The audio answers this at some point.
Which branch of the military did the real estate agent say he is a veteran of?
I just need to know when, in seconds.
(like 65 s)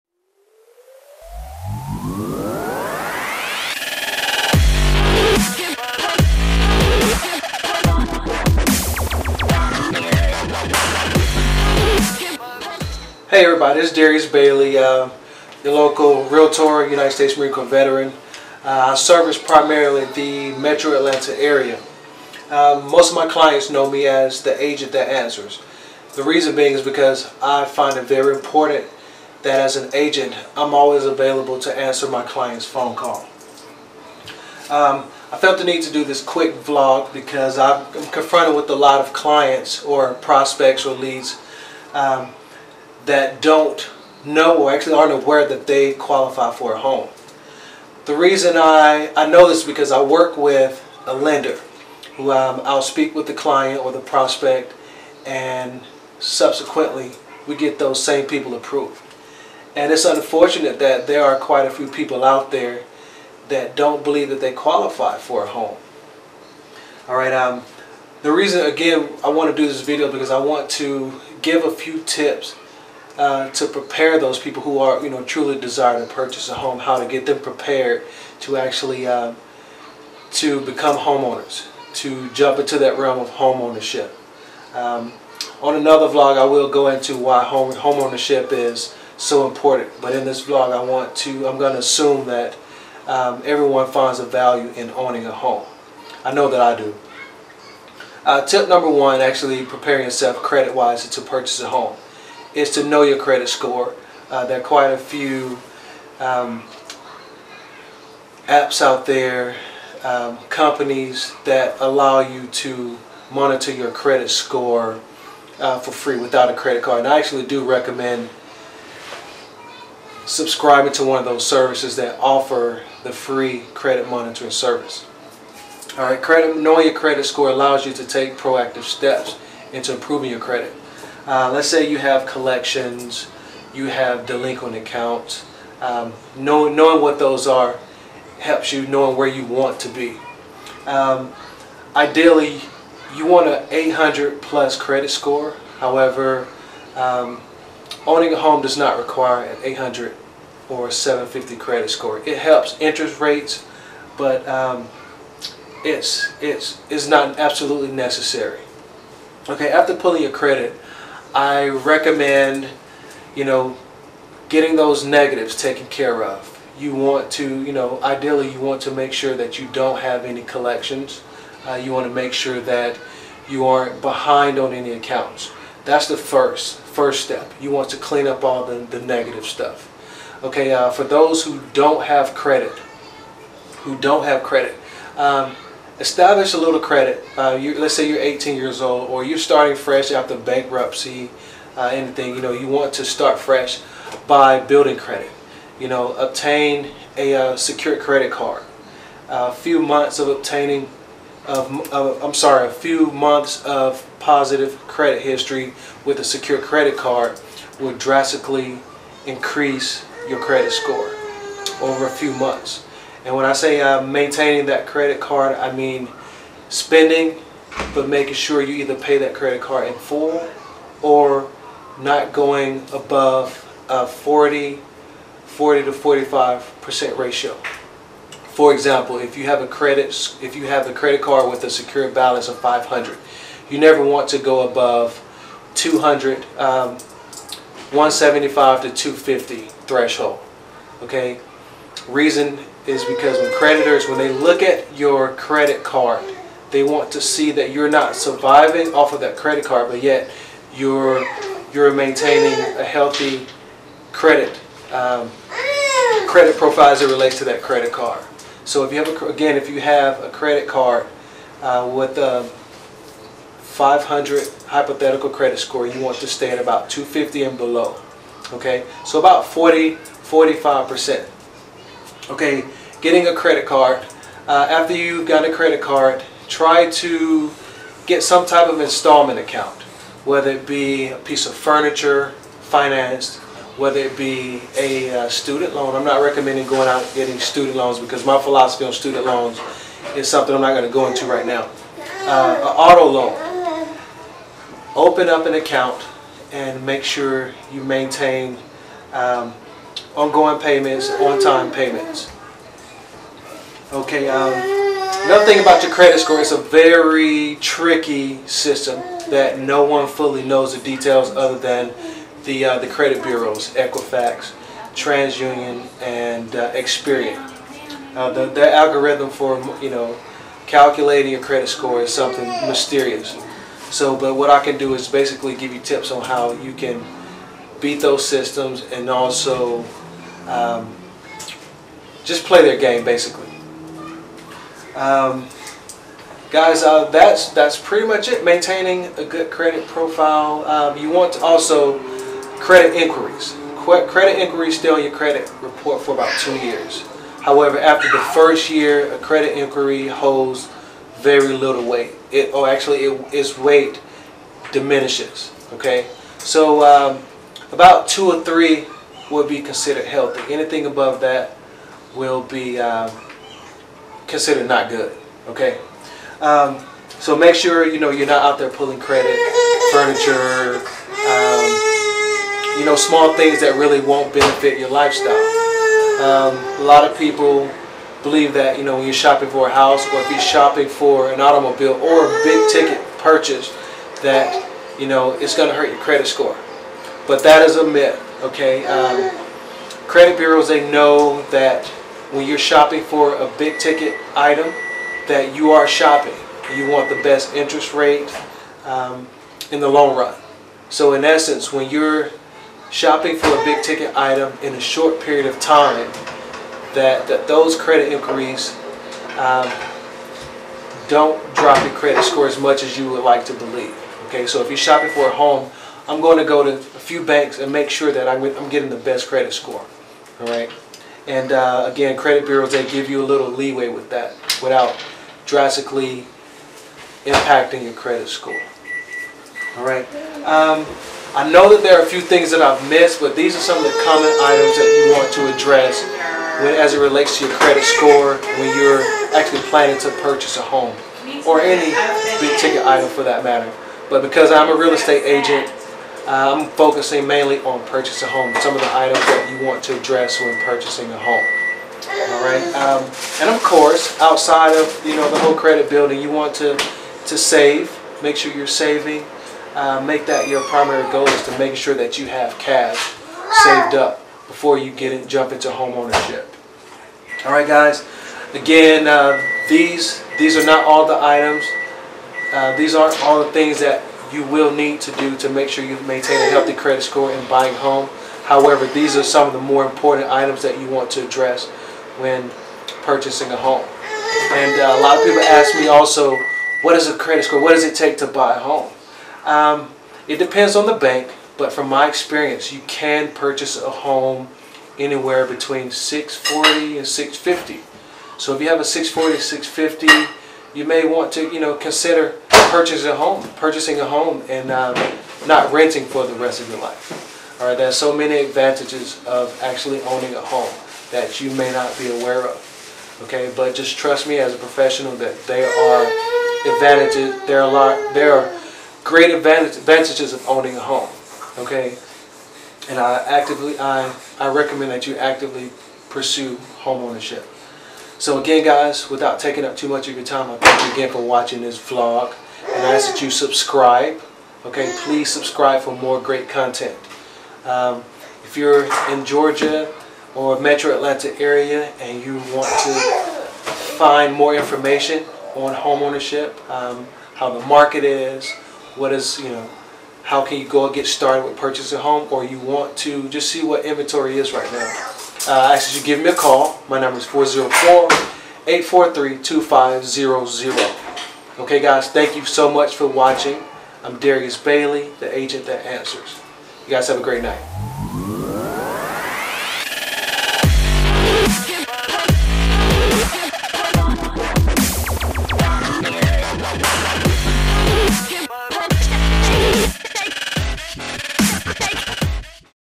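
16 s.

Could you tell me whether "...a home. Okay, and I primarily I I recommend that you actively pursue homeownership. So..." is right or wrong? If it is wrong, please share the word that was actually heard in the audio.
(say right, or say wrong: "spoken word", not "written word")
wrong: "actively", not "primarily".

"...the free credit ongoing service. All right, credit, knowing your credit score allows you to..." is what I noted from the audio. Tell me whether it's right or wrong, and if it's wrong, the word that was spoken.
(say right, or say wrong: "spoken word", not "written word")
wrong: "monitoring", not "ongoing".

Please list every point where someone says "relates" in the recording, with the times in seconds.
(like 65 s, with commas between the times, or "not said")
257 s, 436 s.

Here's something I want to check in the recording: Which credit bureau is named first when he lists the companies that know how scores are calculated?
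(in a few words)
Equifax.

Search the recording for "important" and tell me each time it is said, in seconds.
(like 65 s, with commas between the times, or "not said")
28 s, 89 s, 479 s.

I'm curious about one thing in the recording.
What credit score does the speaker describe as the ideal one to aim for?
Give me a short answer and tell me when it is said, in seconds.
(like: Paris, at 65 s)
800 plus, at 143 s.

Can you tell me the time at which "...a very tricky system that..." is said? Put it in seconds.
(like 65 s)
306 s.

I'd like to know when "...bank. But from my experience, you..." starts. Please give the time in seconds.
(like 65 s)
490 s.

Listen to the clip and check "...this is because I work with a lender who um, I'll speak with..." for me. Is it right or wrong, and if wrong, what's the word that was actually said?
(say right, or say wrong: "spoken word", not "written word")
right.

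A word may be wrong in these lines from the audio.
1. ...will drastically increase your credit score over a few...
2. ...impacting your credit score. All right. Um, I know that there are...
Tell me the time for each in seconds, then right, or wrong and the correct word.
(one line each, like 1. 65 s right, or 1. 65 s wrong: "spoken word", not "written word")
1. 207 s right
2. 427 s right.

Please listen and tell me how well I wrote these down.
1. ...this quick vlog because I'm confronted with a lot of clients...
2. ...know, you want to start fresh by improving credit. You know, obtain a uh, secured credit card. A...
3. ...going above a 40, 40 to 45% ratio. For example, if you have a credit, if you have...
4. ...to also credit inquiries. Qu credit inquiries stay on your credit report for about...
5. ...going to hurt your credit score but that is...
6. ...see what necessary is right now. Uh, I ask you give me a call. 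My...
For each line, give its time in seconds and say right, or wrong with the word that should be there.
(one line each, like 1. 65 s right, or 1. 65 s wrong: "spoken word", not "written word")
1. 36 s right
2. 192 s wrong: "building", not "improving"
3. 222 s right
4. 341 s right
5. 385 s right
6. 553 s wrong: "inventory", not "necessary".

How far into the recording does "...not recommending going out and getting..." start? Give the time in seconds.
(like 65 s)
286 s.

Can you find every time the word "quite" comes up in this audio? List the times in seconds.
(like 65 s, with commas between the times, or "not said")
61 s, 104 s.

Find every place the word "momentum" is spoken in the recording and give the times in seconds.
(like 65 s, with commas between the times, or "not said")
not said.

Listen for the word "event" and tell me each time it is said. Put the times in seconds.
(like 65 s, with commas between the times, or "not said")
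not said.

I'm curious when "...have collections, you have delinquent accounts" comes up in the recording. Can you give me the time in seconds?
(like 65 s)
131 s.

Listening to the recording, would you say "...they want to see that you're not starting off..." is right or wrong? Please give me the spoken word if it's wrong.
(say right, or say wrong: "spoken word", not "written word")
wrong: "surviving", not "starting".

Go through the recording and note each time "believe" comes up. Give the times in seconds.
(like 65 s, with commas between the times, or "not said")
64 s, 378 s, 413 s.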